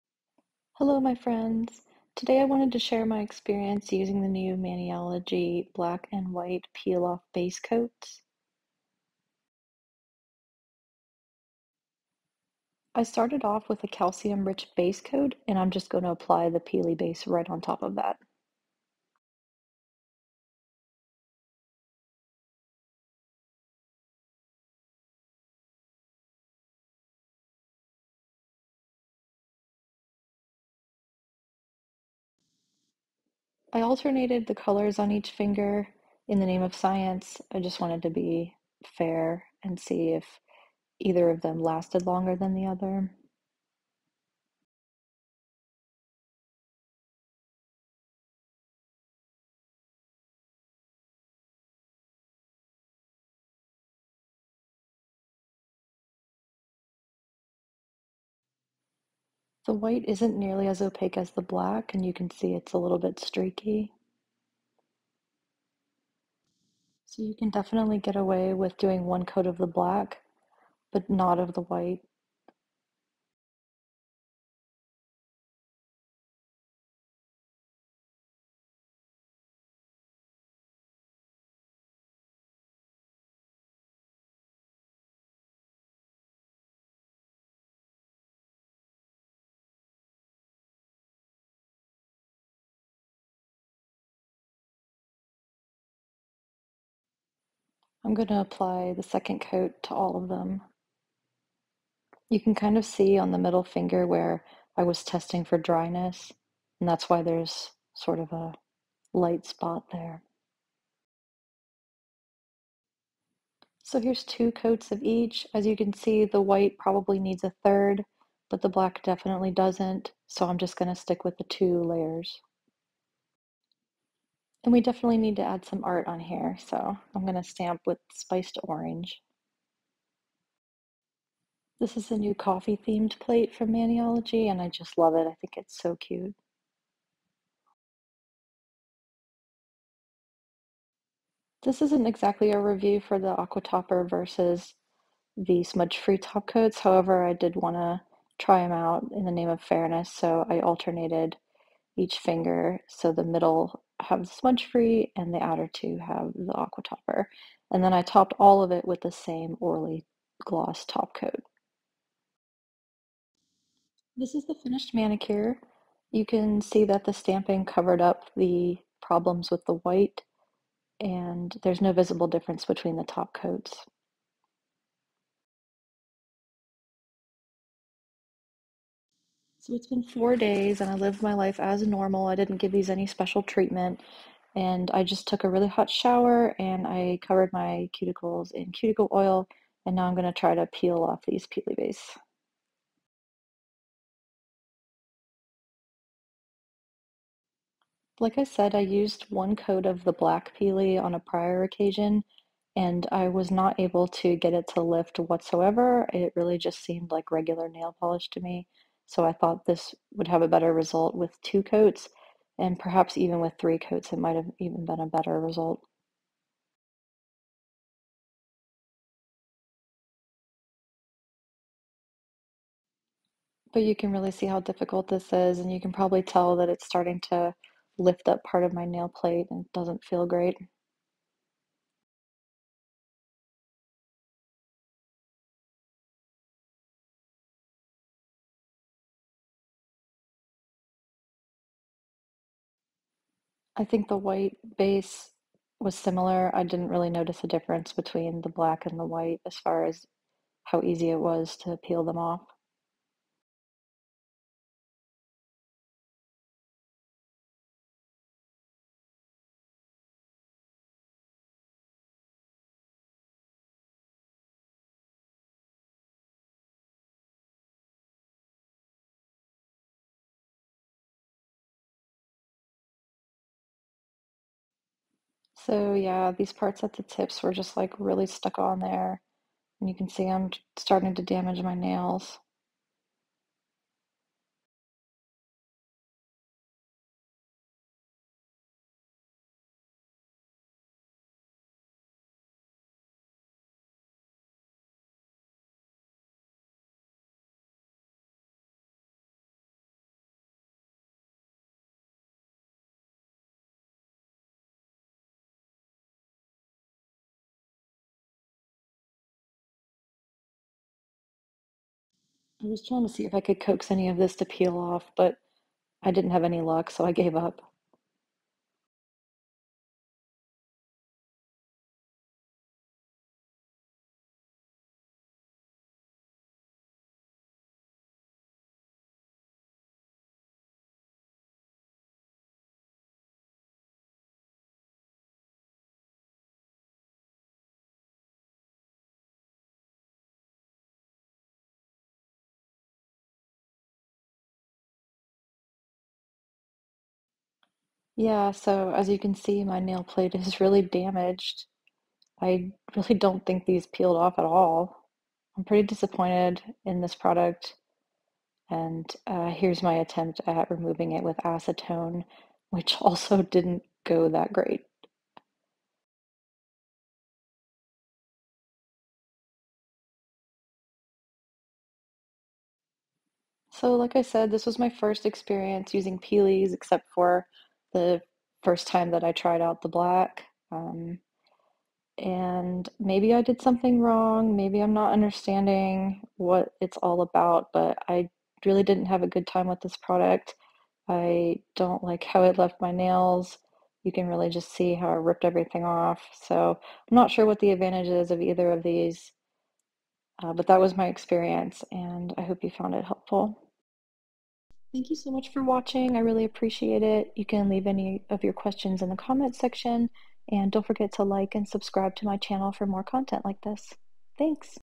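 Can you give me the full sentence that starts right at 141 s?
This isn't exactly a review for the Aqua Topper versus the smudge free top coats.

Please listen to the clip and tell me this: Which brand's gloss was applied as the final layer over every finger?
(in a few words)
Orly.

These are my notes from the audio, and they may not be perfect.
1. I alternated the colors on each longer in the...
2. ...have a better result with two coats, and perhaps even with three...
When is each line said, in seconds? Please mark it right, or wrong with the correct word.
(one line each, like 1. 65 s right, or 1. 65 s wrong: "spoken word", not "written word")
1. 33 s wrong: "finger", not "longer"
2. 210 s right.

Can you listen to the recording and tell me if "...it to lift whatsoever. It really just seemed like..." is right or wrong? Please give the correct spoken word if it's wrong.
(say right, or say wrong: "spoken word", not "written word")
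right.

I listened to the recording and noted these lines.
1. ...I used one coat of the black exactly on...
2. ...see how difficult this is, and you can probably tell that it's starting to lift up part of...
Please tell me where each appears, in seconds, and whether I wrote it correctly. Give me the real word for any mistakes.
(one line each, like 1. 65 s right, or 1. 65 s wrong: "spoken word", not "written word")
1. 198 s wrong: "peely", not "exactly"
2. 224 s right.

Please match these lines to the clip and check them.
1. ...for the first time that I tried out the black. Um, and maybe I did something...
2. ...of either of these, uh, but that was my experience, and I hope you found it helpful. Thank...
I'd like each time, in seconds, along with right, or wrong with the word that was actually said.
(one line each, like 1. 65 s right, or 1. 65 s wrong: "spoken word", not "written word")
1. 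377 s right
2. 398 s right.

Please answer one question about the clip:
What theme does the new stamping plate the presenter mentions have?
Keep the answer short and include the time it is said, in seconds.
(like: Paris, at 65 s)
Coffee, at 132 s.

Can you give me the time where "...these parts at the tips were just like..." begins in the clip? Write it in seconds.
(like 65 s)
276 s.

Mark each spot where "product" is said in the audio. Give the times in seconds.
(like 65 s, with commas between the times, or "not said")
357 s, 389 s.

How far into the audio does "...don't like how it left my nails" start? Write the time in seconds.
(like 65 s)
391 s.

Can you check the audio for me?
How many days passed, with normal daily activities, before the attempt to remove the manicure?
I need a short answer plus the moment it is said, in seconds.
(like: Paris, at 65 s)
4, at 180 s.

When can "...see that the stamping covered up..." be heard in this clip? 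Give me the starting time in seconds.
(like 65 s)
166 s.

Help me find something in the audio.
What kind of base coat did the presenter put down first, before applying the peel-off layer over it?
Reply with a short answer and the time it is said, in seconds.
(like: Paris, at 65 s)
calcium rich base coat, at 13 s.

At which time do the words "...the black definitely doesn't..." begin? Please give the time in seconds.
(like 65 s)
118 s.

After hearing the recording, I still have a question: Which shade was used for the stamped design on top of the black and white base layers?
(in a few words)
Spiced orange.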